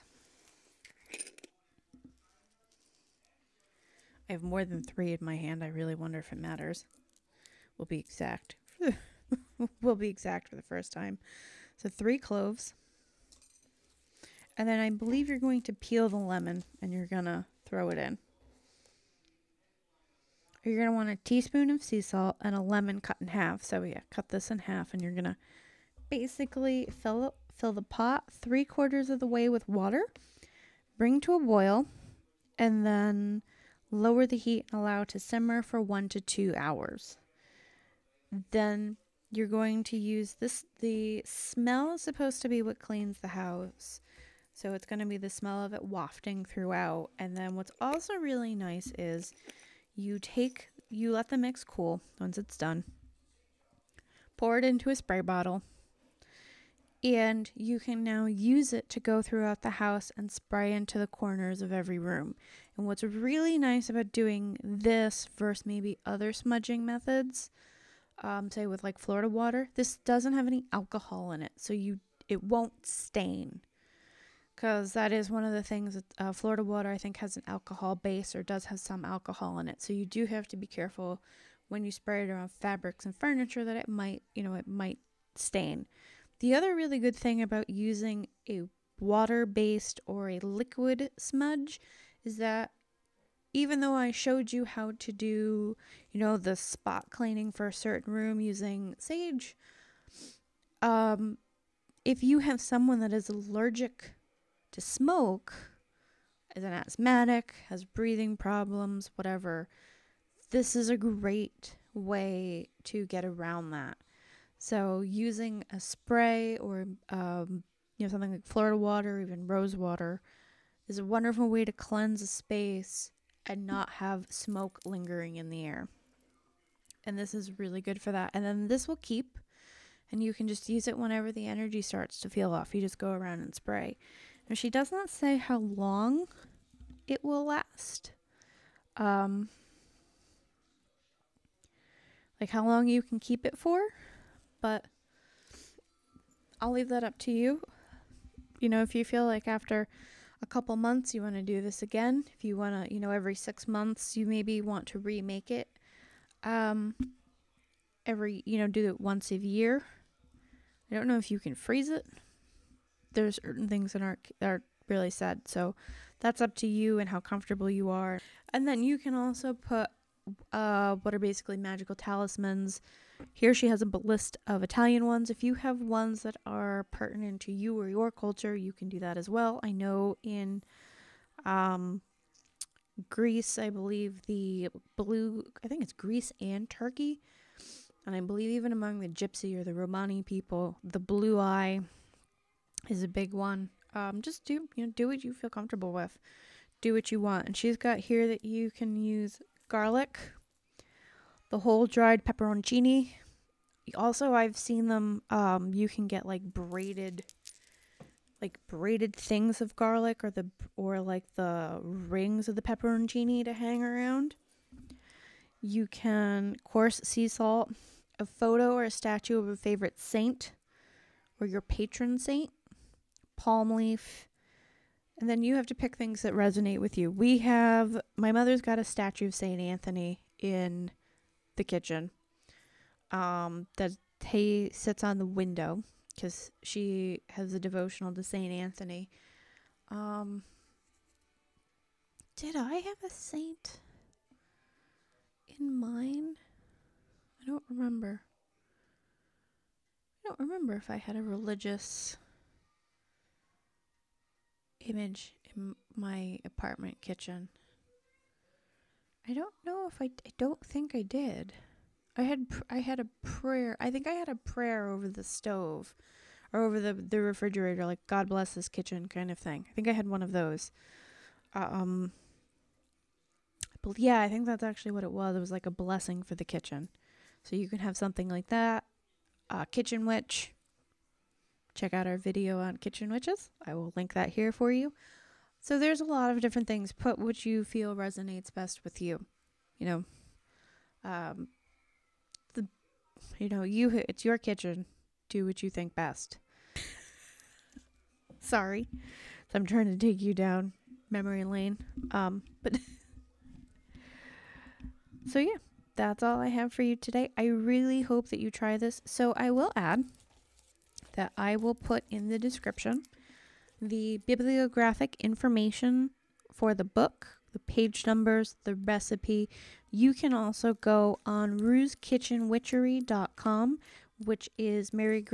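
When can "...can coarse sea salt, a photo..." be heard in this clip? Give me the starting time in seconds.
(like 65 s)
215 s.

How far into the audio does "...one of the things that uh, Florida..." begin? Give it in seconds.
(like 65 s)
75 s.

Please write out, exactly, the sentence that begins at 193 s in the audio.
Um, just do you know do what you feel comfortable with, do what you want.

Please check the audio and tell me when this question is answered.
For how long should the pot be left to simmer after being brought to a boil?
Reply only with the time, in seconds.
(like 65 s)
35 s.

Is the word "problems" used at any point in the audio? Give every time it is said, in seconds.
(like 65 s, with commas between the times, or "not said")
108 s.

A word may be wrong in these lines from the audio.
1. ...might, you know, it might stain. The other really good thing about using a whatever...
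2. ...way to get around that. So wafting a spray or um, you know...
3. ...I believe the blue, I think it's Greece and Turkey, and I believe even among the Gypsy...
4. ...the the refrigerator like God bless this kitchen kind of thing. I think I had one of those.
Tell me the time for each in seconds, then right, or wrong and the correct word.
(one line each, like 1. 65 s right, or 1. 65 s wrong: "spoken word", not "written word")
1. 83 s wrong: "water", not "whatever"
2. 111 s wrong: "using", not "wafting"
3. 183 s right
4. 266 s right.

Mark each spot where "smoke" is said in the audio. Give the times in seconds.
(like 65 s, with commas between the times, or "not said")
104 s, 124 s.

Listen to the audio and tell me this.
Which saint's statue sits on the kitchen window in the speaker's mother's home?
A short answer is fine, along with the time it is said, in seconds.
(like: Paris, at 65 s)
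St. Anthony, at 229 s.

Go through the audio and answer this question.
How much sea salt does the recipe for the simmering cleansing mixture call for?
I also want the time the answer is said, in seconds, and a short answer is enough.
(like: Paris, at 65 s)
1 teaspoon, at 21 s.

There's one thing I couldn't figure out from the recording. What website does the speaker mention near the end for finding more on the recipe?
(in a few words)
rueskitchenwitchery.com.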